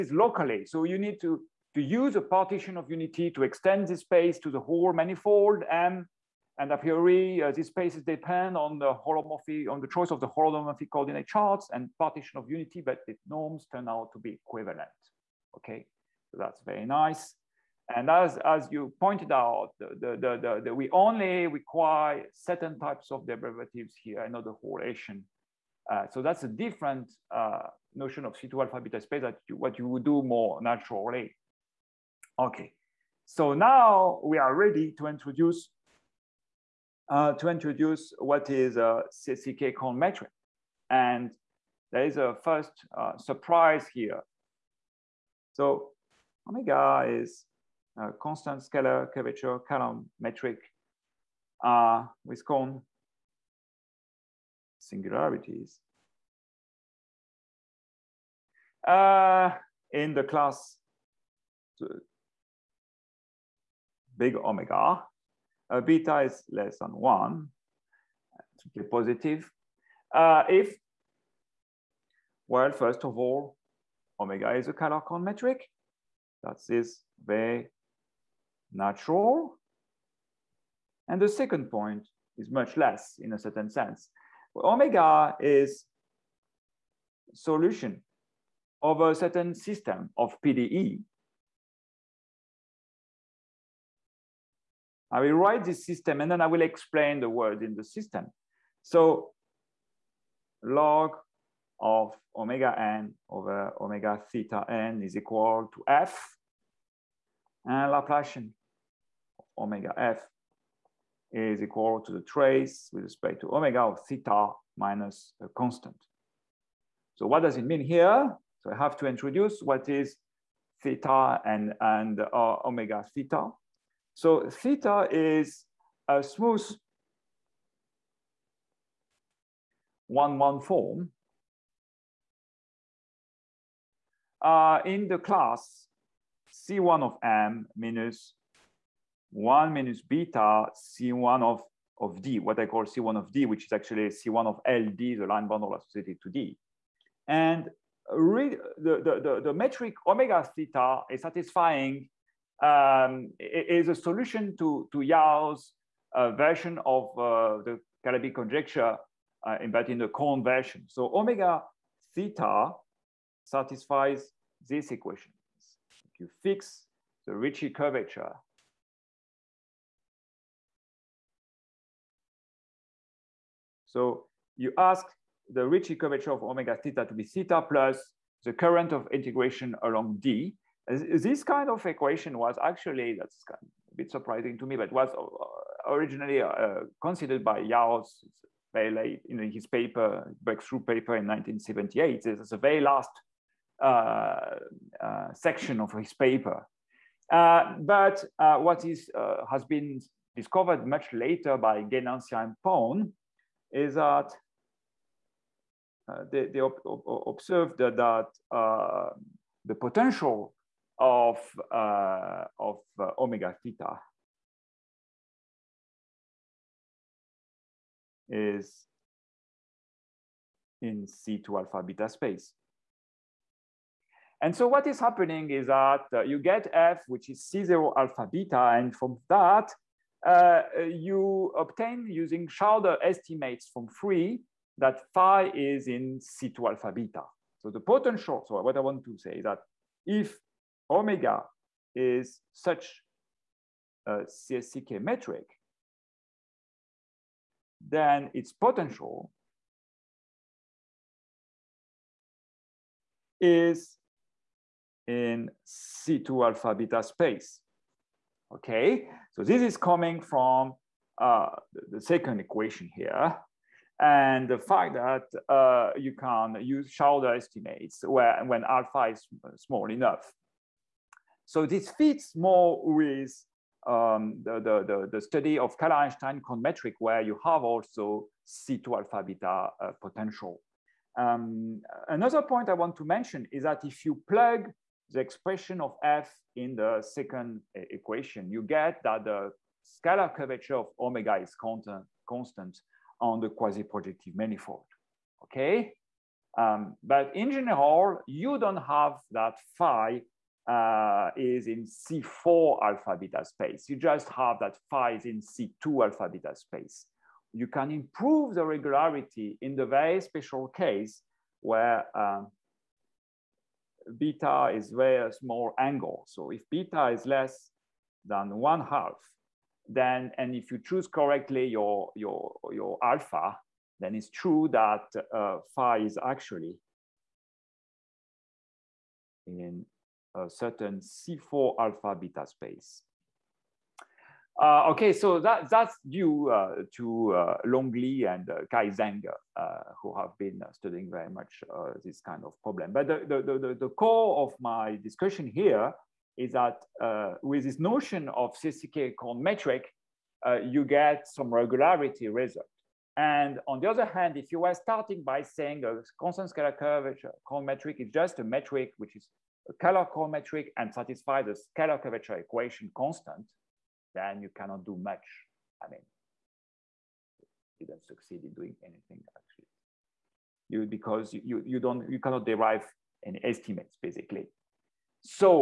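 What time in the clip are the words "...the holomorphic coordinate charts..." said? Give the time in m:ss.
0:10.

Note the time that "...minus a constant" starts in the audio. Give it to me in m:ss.
1:54.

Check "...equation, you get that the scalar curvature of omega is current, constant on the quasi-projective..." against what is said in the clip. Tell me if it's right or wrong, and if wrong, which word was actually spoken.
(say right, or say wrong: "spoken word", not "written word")
wrong: "constant", not "current".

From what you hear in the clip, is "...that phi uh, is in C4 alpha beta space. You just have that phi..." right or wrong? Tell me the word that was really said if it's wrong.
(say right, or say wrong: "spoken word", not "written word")
right.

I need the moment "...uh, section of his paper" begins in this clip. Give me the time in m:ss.
3:15.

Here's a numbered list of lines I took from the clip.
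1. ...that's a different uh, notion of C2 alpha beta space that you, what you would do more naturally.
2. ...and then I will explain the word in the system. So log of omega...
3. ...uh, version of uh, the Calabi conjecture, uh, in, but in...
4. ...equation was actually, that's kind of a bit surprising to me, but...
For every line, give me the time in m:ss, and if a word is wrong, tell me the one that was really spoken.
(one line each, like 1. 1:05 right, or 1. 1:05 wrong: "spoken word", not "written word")
1. 0:26 right
2. 1:36 right
3. 2:36 right
4. 3:01 right.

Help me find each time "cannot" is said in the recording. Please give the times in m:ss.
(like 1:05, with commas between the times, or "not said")
6:04, 6:12.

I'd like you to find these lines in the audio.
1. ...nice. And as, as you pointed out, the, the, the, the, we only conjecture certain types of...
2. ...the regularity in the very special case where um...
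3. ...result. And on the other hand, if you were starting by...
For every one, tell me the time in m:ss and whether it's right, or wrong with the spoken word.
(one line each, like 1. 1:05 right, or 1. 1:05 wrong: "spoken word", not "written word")
1. 0:16 wrong: "require", not "conjecture"
2. 5:08 right
3. 5:52 right.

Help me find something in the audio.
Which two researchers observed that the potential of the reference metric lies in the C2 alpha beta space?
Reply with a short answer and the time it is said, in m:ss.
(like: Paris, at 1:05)
Guenancia and Păun, at 3:21.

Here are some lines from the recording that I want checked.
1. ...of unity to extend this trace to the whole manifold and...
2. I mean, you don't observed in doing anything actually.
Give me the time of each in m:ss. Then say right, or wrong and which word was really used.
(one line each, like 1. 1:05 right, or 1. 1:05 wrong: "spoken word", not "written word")
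1. 0:02 wrong: "space", not "trace"
2. 6:05 wrong: "succeed", not "observed".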